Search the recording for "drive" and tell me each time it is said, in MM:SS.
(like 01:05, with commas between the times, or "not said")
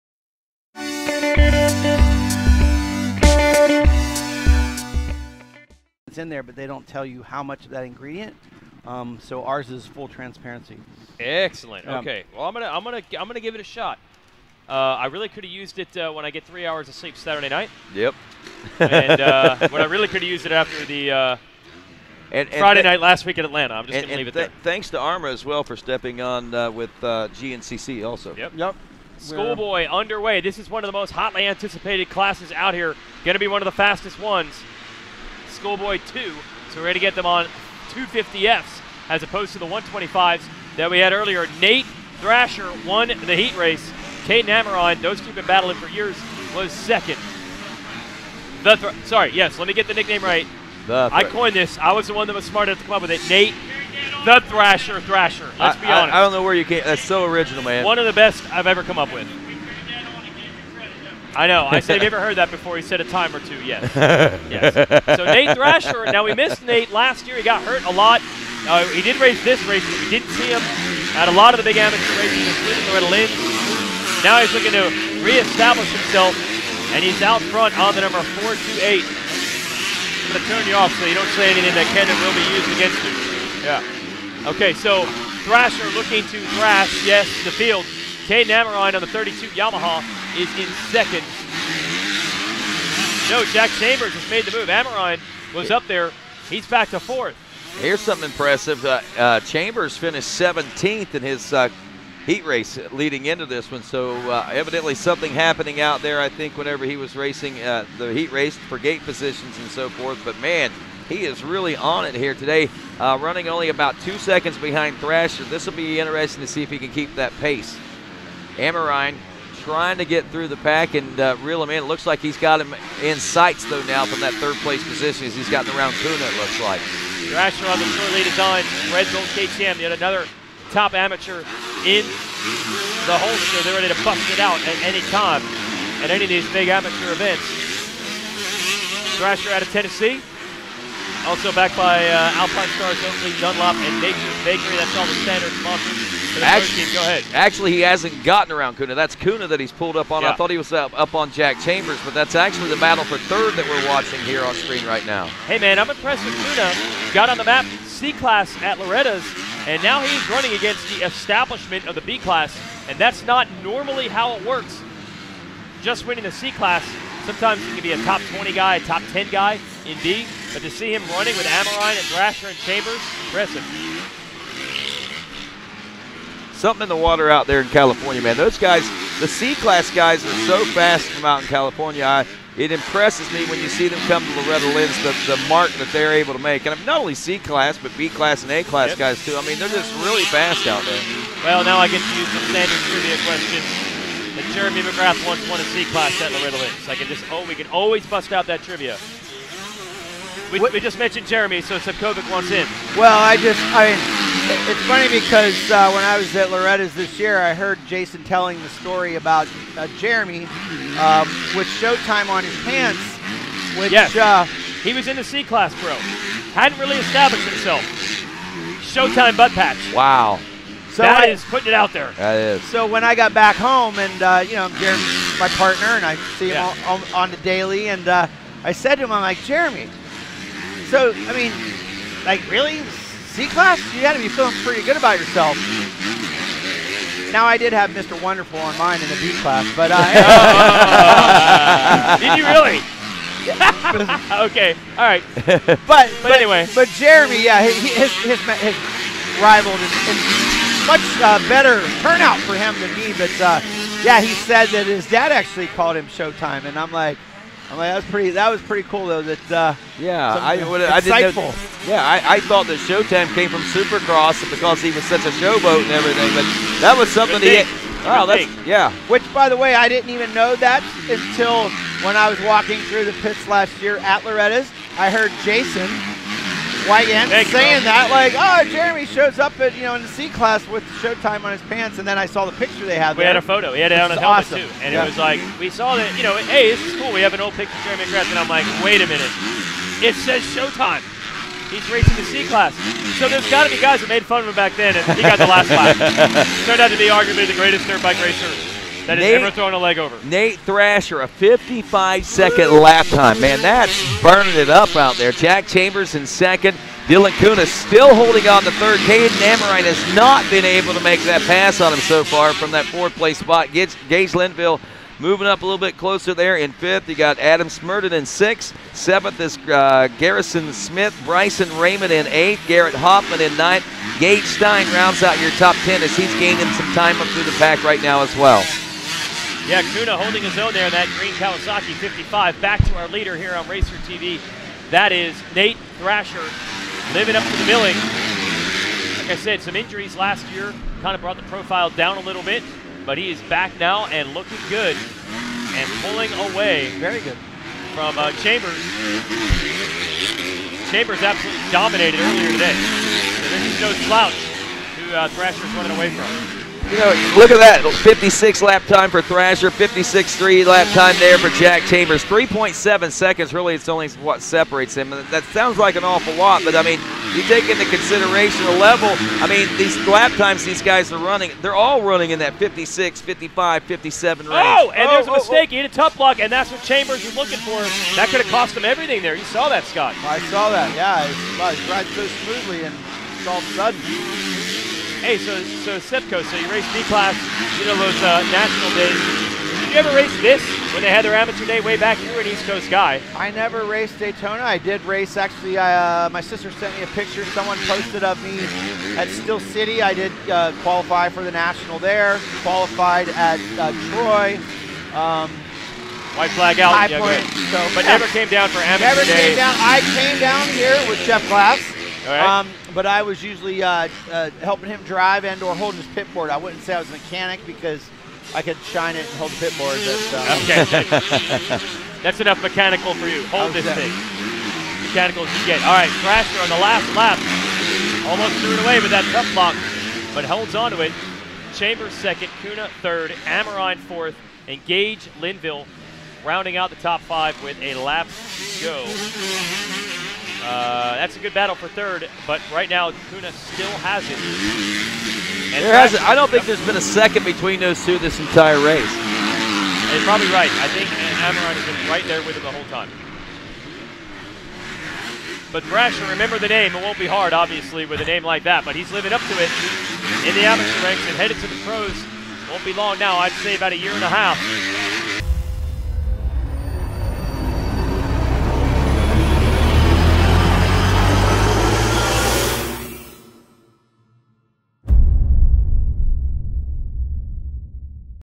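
06:55.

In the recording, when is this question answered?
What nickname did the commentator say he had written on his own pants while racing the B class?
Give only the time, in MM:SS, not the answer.
03:57.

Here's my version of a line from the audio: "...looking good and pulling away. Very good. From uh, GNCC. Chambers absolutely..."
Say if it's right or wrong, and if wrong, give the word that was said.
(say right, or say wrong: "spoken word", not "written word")
wrong: "Chambers", not "GNCC".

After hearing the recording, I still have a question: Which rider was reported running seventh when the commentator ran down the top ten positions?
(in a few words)
Garrison Smith.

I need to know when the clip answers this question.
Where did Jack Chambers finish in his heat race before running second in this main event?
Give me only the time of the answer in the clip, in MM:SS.
01:40.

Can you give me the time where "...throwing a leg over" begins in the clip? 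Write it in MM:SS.
04:59.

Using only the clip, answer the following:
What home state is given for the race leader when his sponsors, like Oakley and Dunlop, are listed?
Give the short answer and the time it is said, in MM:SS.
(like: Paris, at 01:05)
Tennessee, at 02:19.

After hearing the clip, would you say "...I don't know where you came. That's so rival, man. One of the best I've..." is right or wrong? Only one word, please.
wrong.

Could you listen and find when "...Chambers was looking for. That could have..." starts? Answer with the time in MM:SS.
06:16.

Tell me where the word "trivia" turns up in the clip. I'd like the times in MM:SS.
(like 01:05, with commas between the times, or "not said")
03:12, 03:18.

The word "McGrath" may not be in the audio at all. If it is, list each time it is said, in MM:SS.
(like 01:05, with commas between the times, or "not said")
03:14, 04:48.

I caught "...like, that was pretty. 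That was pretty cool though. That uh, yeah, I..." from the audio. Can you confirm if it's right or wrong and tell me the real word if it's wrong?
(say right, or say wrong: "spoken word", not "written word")
right.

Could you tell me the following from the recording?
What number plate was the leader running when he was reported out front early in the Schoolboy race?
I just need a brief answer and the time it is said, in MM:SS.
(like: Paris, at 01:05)
428, at 01:18.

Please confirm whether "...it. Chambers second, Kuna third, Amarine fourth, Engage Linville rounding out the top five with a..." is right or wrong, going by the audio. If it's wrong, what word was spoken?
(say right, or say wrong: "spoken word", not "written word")
right.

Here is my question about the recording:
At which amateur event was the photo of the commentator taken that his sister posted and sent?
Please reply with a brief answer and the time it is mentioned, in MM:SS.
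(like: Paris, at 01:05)
Steel City, at 06:39.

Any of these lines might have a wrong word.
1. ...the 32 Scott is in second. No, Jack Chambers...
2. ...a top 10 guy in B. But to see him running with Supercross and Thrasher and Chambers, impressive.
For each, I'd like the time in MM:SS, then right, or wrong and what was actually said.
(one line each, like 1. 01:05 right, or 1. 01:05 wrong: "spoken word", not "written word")
1. 01:29 wrong: "Yamaha", not "Scott"
2. 02:48 wrong: "Amarine", not "Supercross".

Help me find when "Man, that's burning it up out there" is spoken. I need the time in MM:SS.
05:03.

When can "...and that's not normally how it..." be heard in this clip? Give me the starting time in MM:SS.
02:42.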